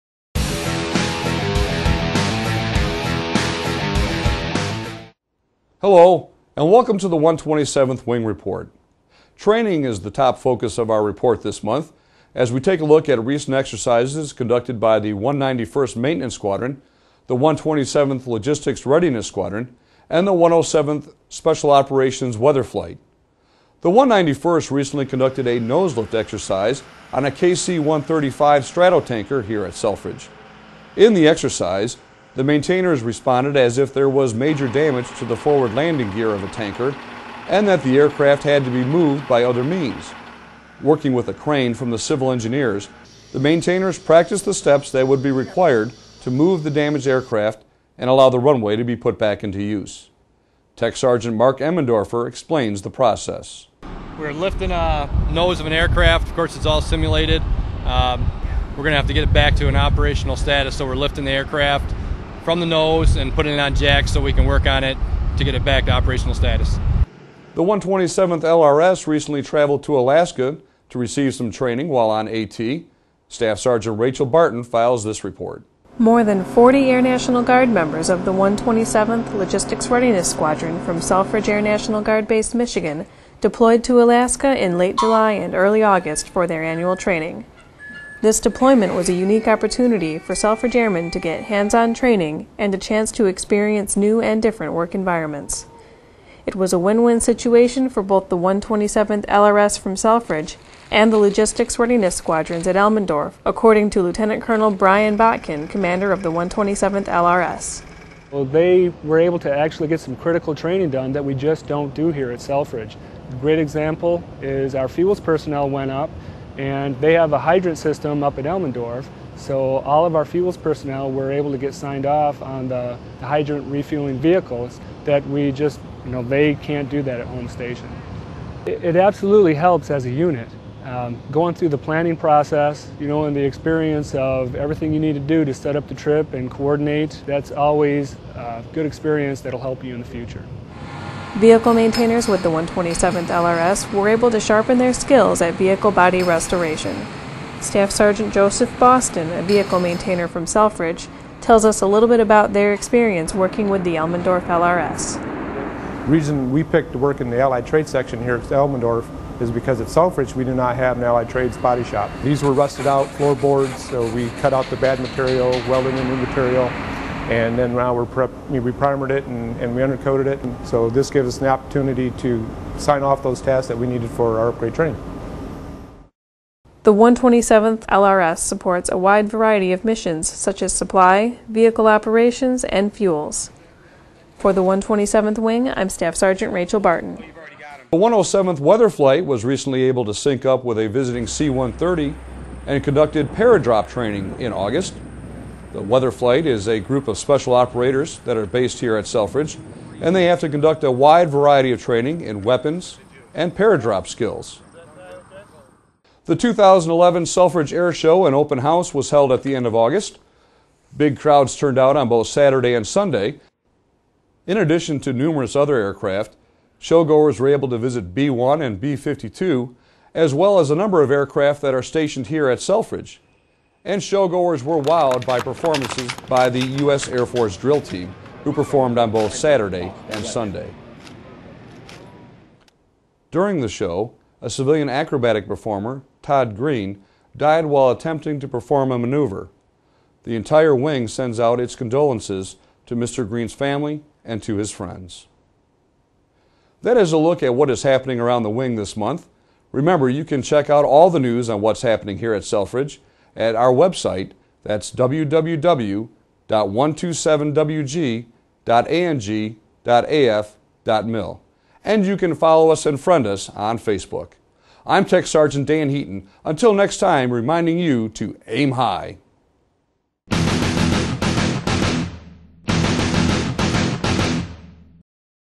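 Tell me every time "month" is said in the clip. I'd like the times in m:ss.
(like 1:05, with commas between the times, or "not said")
0:11, 4:08.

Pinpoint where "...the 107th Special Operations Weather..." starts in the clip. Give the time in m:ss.
0:20.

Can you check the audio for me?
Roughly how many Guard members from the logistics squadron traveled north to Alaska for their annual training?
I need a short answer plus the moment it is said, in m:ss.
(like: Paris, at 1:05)
More than 40, at 1:15.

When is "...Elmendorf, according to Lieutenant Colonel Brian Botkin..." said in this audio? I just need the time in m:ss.
1:42.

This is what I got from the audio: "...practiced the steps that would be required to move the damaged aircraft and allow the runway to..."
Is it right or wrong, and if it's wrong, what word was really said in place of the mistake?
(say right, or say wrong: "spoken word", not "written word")
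right.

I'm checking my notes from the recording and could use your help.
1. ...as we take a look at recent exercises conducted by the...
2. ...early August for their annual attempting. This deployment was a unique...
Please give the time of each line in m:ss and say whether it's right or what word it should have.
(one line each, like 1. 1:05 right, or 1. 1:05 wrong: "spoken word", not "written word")
1. 0:12 right
2. 1:25 wrong: "training", not "attempting".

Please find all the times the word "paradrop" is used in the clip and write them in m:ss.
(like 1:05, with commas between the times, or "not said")
3:13, 3:23.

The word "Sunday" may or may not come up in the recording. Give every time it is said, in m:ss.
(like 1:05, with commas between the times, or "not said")
3:32, 3:50.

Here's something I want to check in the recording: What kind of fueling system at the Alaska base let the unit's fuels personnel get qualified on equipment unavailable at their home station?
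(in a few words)
Hydrant system.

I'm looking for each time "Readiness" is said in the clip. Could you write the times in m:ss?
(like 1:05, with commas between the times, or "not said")
0:18, 1:19, 1:41.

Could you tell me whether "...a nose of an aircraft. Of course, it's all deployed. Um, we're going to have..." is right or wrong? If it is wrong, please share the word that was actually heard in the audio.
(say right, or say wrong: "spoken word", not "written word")
wrong: "simulated", not "deployed".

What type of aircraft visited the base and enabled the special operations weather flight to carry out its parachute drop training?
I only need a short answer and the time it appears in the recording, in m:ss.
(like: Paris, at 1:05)
C-130, at 3:11.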